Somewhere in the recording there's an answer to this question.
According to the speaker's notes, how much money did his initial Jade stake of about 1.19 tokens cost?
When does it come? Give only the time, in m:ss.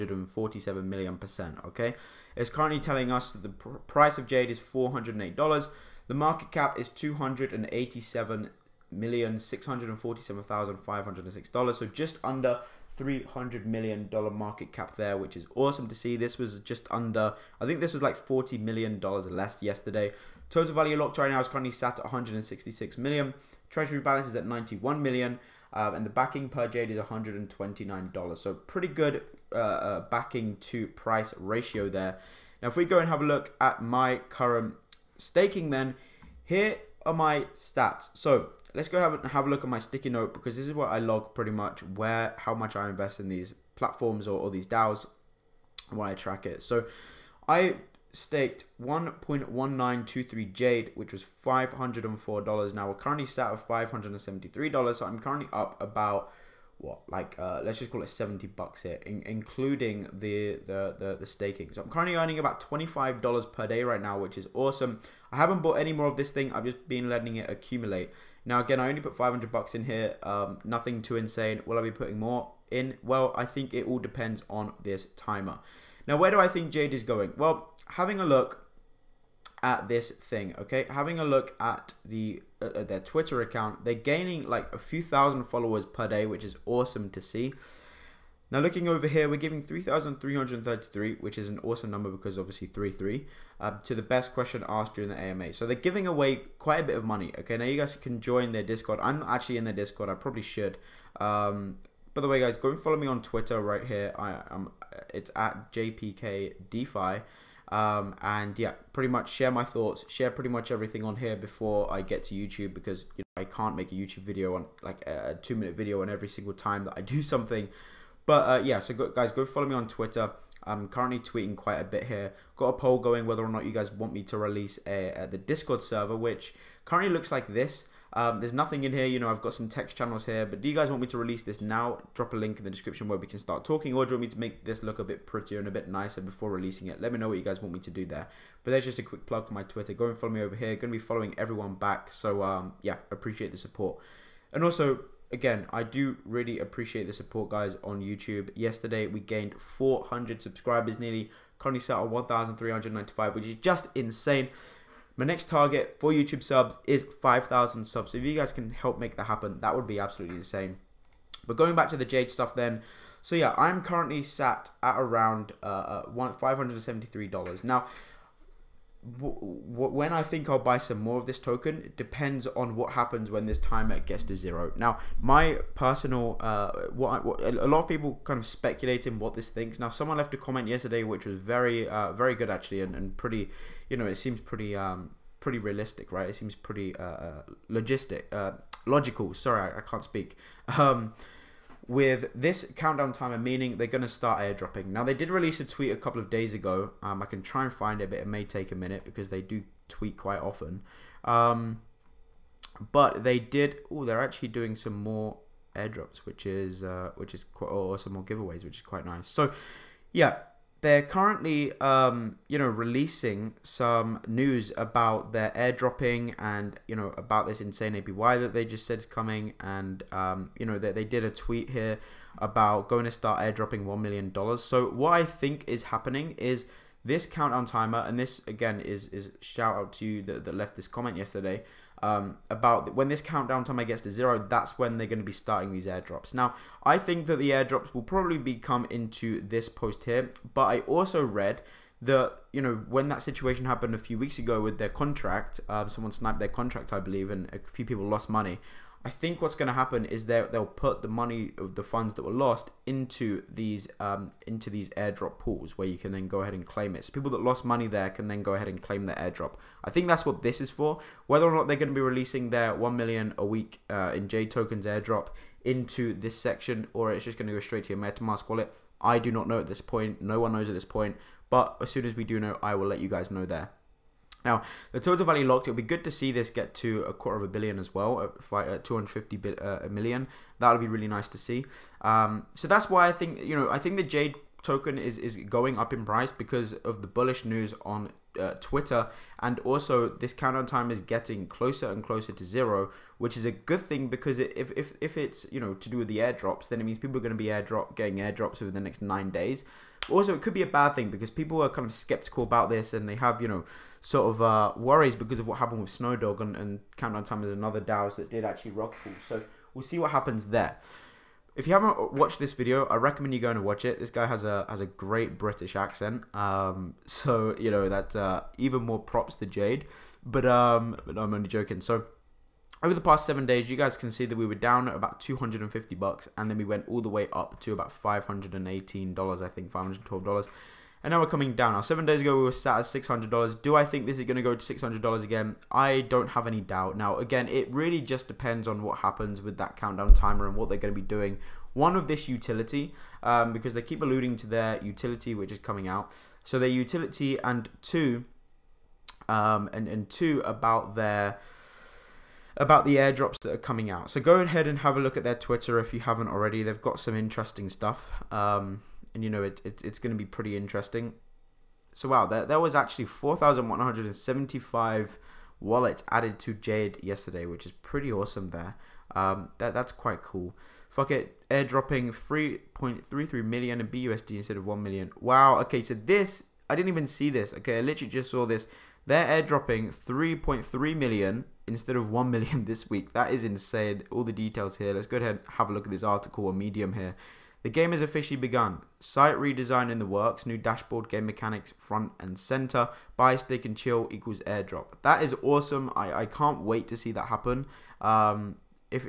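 0:51.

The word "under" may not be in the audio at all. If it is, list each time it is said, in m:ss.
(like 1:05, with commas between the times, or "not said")
0:12, 0:16.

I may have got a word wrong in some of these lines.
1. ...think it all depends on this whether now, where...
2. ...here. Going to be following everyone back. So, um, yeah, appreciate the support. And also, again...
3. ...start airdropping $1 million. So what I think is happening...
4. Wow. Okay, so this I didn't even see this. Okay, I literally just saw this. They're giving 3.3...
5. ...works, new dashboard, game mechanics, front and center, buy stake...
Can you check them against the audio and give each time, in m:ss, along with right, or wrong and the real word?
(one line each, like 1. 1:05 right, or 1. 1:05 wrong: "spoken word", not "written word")
1. 1:13 wrong: "timer", not "whether"
2. 2:20 right
3. 3:43 right
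4. 6:15 wrong: "airdropping", not "giving"
5. 6:30 right.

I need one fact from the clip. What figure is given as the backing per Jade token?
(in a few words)
$129.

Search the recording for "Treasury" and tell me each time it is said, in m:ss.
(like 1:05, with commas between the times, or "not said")
0:23.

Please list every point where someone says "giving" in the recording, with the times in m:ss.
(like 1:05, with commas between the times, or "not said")
1:29, 1:35.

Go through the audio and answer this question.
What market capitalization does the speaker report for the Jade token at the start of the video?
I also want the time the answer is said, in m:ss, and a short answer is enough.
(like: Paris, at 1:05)
$287 million, at 0:06.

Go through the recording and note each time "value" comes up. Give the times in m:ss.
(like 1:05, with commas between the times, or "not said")
0:20, 4:35.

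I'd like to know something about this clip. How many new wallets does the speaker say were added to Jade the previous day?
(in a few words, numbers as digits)
4,175.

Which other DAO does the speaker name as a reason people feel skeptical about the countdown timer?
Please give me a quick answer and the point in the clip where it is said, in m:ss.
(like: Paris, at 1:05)
Snowdog, at 5:05.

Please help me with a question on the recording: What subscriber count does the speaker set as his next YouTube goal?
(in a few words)
5,000.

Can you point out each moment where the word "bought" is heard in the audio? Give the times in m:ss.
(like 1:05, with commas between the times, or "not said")
1:05.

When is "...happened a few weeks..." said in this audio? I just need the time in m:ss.
4:03.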